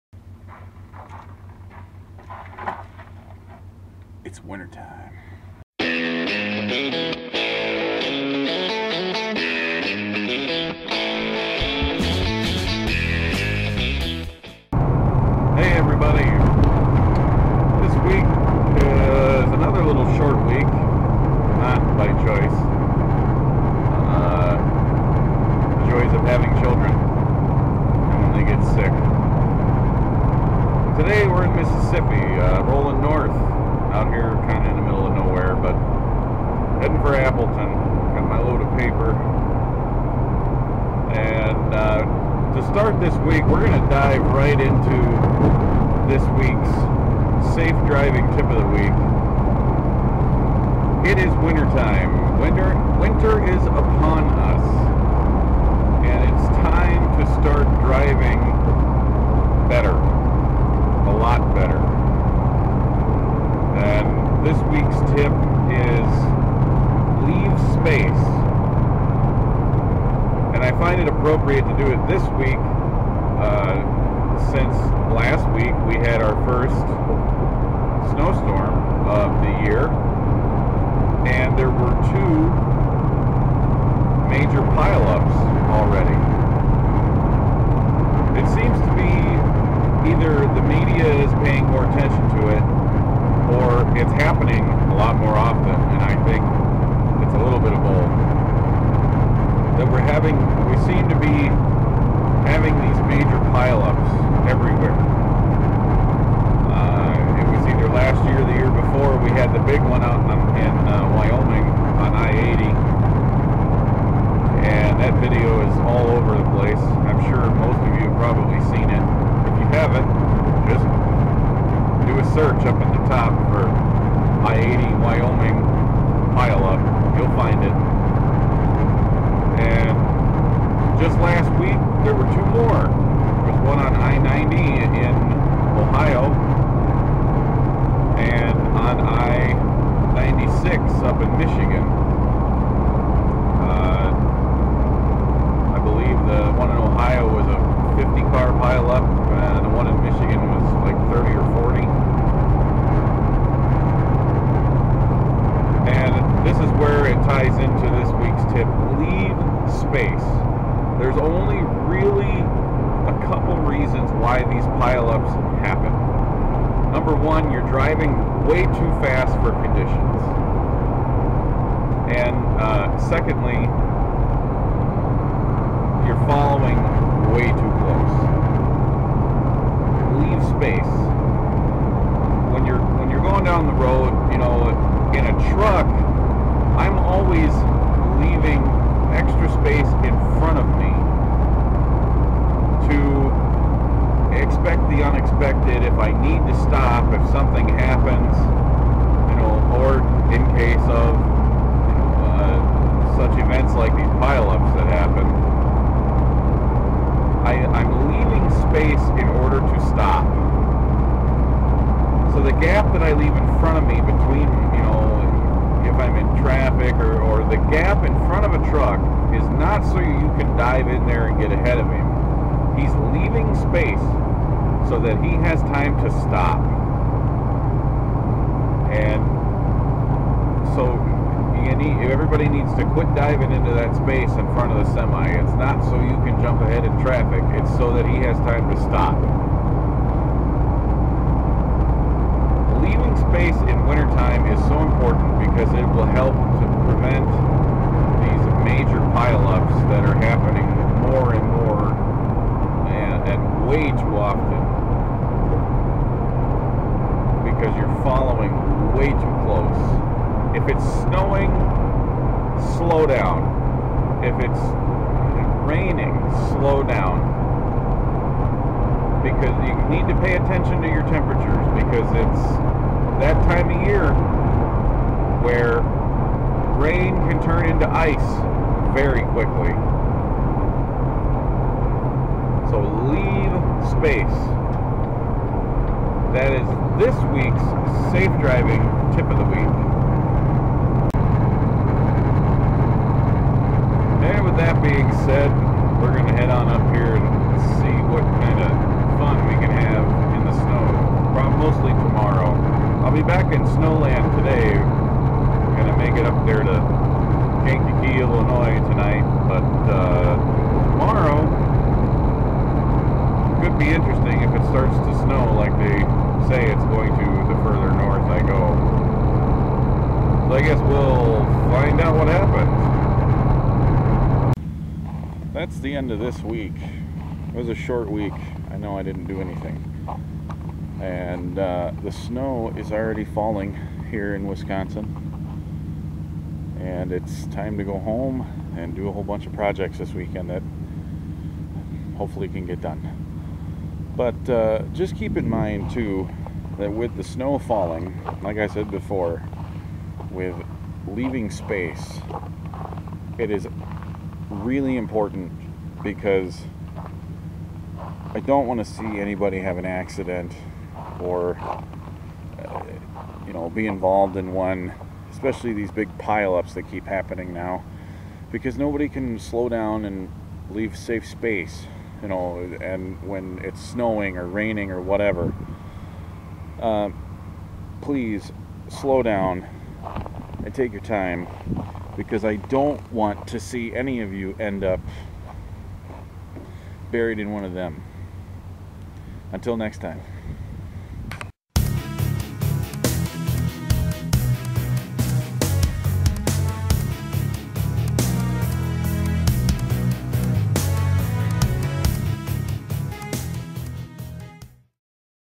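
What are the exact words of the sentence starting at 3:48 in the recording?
And so everybody needs to quit diving into that space in front of the semi.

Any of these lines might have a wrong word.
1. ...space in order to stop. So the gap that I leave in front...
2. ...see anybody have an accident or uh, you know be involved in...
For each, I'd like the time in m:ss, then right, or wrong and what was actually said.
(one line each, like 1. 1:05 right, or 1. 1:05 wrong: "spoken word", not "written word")
1. 3:28 right
2. 5:58 right.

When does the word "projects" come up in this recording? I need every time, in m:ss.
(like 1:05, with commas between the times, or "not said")
5:39.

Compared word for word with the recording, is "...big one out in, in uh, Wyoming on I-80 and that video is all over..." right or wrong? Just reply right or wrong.
right.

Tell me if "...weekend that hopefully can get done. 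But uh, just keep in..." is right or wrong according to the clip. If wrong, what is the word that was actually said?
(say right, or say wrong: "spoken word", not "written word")
right.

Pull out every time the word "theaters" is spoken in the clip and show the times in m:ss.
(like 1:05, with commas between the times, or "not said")
not said.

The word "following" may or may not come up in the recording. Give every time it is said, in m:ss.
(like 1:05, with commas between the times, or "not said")
2:56, 4:18.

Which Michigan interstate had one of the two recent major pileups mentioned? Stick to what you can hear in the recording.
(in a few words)
I-96.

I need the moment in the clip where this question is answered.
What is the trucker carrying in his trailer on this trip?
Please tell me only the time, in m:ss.
0:38.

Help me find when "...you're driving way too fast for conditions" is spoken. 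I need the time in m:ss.
2:47.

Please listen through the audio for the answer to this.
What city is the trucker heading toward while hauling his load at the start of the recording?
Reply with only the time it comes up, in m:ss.
0:37.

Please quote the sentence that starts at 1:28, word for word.
It seems either the media is paying more attention to it or it's happening a lot more often.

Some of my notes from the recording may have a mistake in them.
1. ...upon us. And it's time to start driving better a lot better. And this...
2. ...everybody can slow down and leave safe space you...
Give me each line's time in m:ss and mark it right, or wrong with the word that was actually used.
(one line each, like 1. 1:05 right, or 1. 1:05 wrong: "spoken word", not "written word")
1. 0:53 right
2. 6:08 wrong: "nobody", not "everybody".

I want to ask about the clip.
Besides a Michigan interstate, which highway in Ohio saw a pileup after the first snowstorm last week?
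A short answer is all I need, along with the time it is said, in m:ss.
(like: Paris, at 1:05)
I-90, at 2:13.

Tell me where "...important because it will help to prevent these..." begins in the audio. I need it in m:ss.
4:04.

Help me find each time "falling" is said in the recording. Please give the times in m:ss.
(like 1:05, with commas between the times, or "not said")
5:33, 5:47.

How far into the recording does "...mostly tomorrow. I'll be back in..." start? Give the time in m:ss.
5:01.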